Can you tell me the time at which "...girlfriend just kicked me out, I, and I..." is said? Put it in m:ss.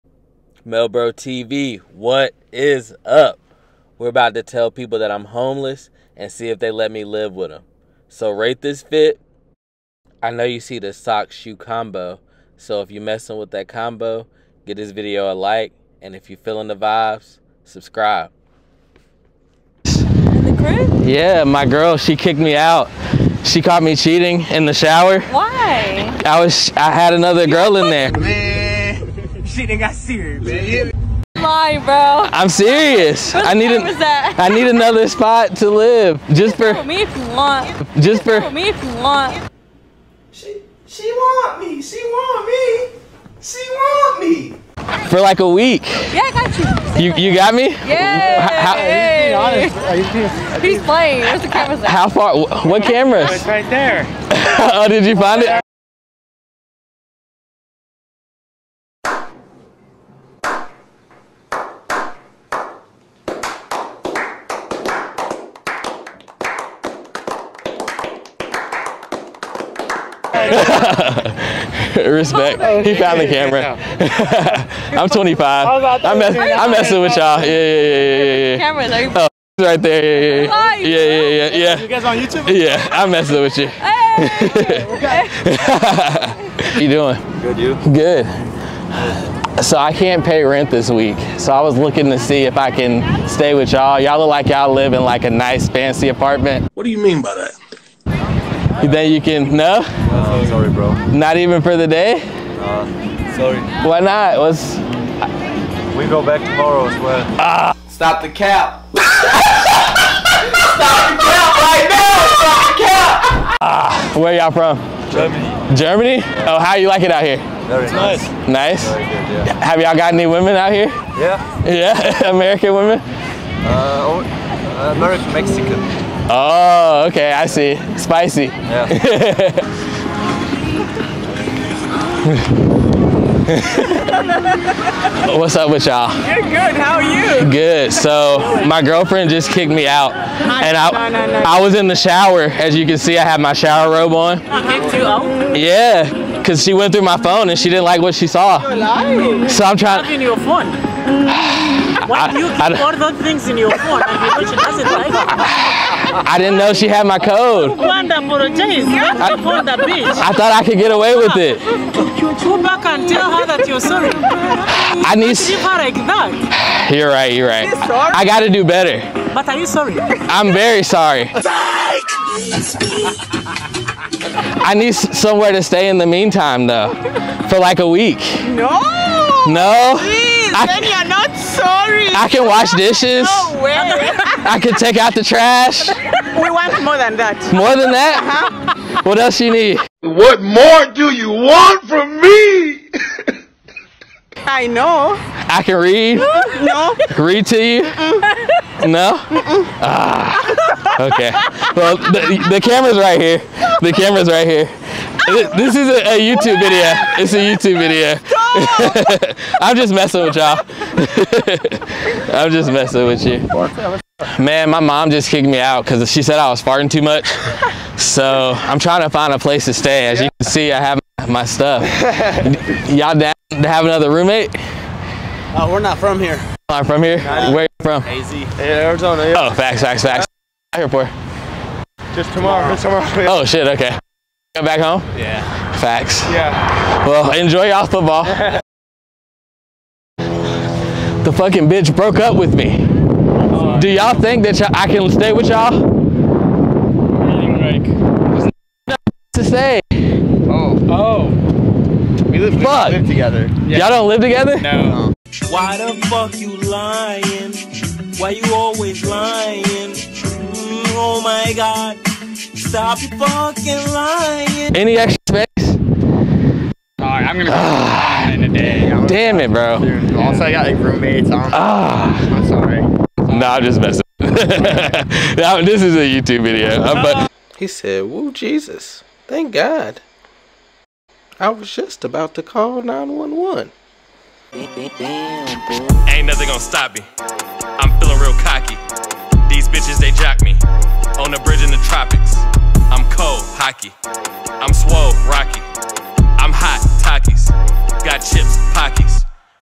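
2:18.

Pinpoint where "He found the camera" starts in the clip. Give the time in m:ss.
1:12.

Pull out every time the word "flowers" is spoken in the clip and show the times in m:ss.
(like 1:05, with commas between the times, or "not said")
not said.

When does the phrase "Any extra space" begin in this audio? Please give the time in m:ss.
4:24.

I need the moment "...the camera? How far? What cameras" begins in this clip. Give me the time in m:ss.
0:51.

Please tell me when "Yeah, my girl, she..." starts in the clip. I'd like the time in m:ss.
0:21.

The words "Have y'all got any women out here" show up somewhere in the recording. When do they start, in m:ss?
1:59.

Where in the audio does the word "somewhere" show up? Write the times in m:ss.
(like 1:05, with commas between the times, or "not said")
2:54.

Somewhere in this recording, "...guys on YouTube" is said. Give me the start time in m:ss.
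1:21.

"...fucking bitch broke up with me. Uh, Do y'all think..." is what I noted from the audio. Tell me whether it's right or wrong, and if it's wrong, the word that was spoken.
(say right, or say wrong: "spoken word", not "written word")
right.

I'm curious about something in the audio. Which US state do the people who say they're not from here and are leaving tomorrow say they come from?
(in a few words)
Arizona.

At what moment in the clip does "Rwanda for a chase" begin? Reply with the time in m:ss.
2:37.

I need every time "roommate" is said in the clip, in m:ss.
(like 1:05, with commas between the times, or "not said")
3:44, 4:30.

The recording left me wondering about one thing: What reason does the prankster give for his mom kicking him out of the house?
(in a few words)
Farting too much.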